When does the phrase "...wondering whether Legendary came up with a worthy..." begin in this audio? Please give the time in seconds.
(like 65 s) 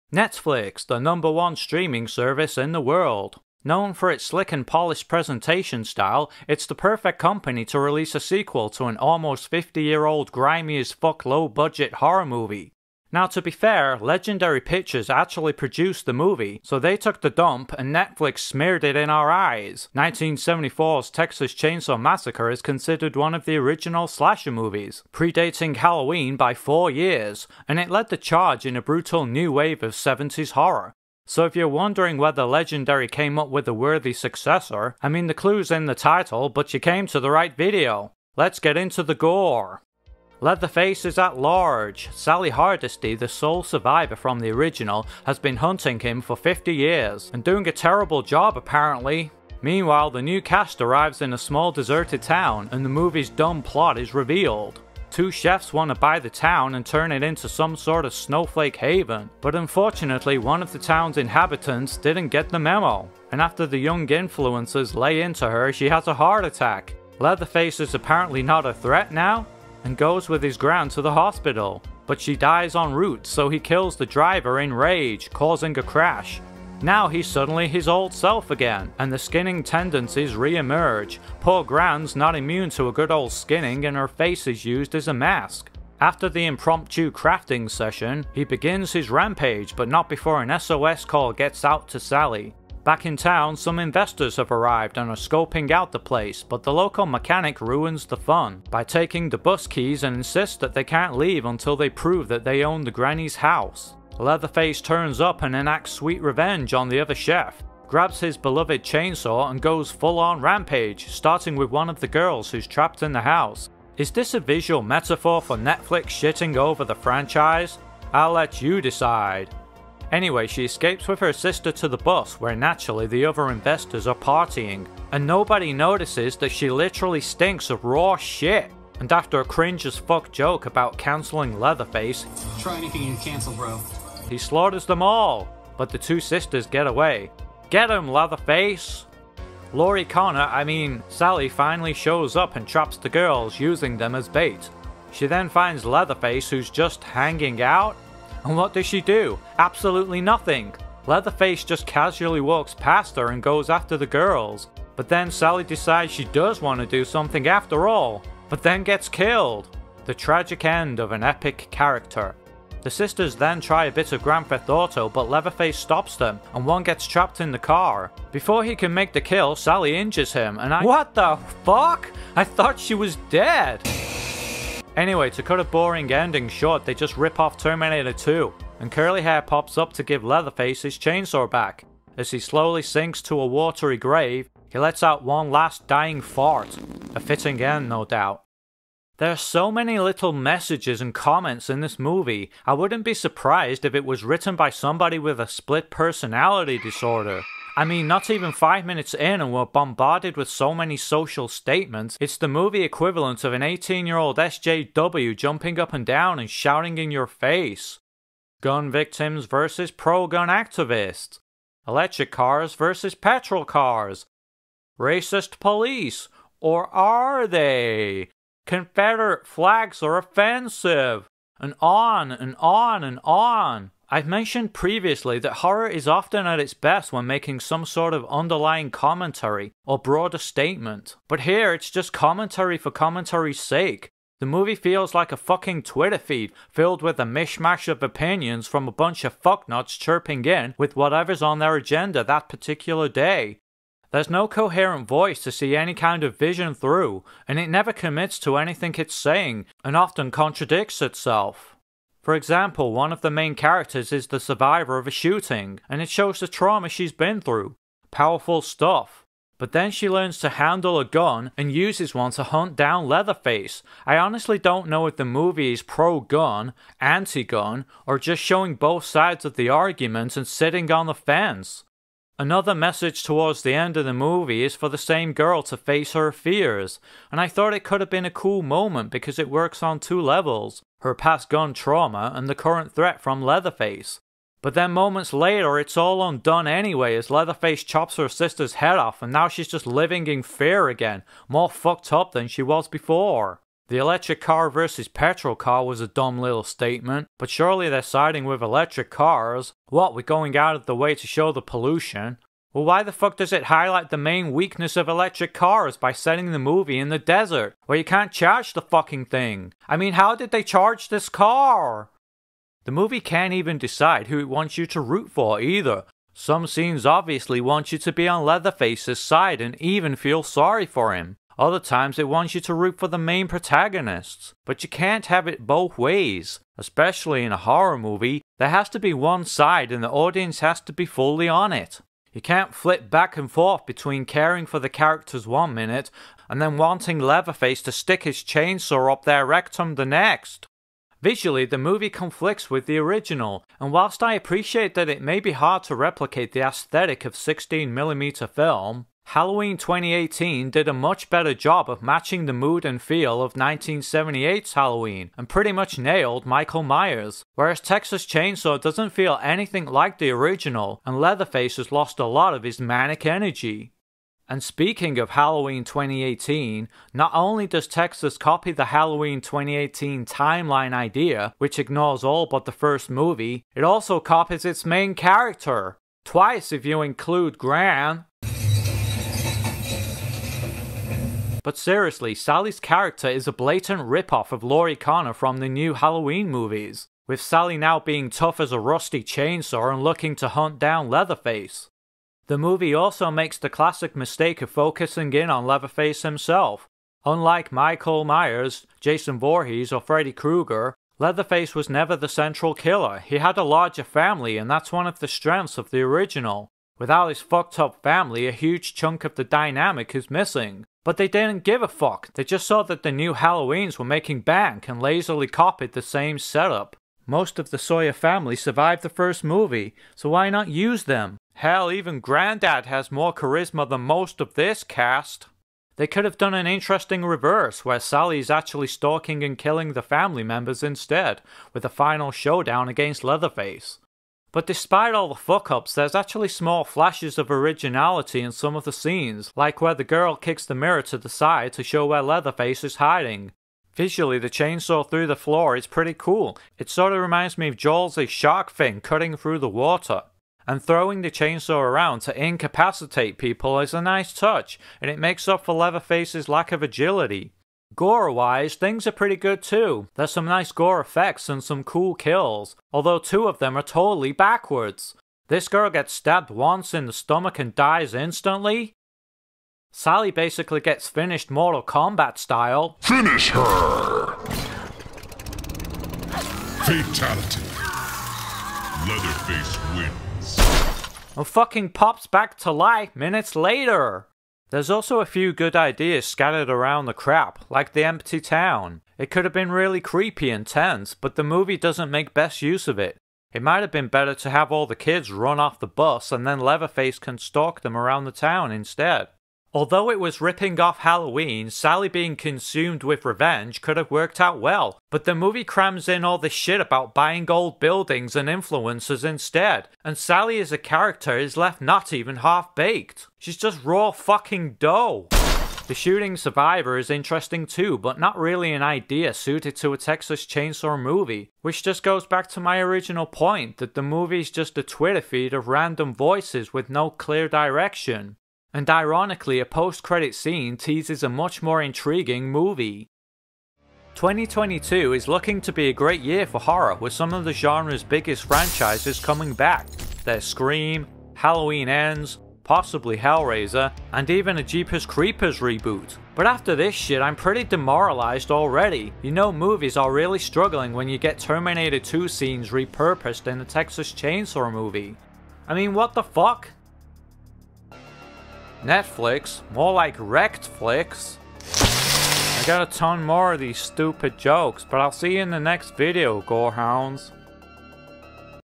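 31 s.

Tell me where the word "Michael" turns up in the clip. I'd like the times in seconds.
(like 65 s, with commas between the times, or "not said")
356 s, 397 s.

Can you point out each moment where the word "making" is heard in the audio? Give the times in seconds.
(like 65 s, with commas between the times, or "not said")
227 s, 414 s.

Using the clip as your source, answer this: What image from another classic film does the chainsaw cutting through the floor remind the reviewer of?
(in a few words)
Jaws' shark fin.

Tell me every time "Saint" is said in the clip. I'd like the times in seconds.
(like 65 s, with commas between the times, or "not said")
not said.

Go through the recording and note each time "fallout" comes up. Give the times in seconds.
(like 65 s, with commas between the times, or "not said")
not said.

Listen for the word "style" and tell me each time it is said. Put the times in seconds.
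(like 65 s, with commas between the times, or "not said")
5 s, 472 s.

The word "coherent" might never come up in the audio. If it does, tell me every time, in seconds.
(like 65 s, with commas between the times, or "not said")
244 s.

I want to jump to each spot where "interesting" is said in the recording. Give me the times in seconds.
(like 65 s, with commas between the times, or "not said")
426 s, 517 s.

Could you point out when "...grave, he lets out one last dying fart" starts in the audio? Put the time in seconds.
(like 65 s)
183 s.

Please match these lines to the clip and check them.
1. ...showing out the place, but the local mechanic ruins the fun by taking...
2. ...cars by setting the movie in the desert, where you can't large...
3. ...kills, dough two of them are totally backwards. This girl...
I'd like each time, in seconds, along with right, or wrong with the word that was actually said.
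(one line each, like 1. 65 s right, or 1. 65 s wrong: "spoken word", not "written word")
1. 95 s wrong: "scoping", not "showing"
2. 305 s wrong: "charge", not "large"
3. 462 s wrong: "although", not "dough".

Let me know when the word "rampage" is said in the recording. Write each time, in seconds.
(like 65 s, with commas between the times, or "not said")
89 s, 110 s.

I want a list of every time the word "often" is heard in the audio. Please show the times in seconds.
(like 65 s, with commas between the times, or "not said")
226 s, 249 s.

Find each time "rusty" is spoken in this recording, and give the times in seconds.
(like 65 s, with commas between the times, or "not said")
388 s.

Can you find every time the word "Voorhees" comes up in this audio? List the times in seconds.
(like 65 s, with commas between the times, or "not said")
399 s.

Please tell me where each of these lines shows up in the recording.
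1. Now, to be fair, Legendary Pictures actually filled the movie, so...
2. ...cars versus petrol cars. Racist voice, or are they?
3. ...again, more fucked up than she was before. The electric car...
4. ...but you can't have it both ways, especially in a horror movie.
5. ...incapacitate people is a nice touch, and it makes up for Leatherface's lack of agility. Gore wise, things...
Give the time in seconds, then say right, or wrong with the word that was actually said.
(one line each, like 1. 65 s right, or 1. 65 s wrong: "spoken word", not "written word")
1. 13 s wrong: "produced", not "filled"
2. 212 s wrong: "police", not "voice"
3. 290 s right
4. 324 s right
5. 452 s right.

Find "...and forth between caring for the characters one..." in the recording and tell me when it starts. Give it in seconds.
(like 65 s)
333 s.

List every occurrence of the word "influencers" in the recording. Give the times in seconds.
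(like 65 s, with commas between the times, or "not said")
64 s, 508 s.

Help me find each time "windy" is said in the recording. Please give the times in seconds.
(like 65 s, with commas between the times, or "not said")
not said.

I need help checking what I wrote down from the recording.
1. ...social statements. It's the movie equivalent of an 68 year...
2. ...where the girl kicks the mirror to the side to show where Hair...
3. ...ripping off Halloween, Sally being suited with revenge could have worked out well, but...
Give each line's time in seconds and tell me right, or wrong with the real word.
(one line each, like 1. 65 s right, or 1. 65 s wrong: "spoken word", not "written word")
1. 200 s wrong: "18", not "68"
2. 439 s wrong: "Leatherface", not "Hair"
3. 500 s wrong: "consumed", not "suited".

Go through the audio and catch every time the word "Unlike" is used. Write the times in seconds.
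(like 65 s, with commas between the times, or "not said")
397 s.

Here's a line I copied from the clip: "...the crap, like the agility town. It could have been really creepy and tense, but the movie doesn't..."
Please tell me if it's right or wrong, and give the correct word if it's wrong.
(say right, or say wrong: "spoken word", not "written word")
wrong: "empty", not "agility".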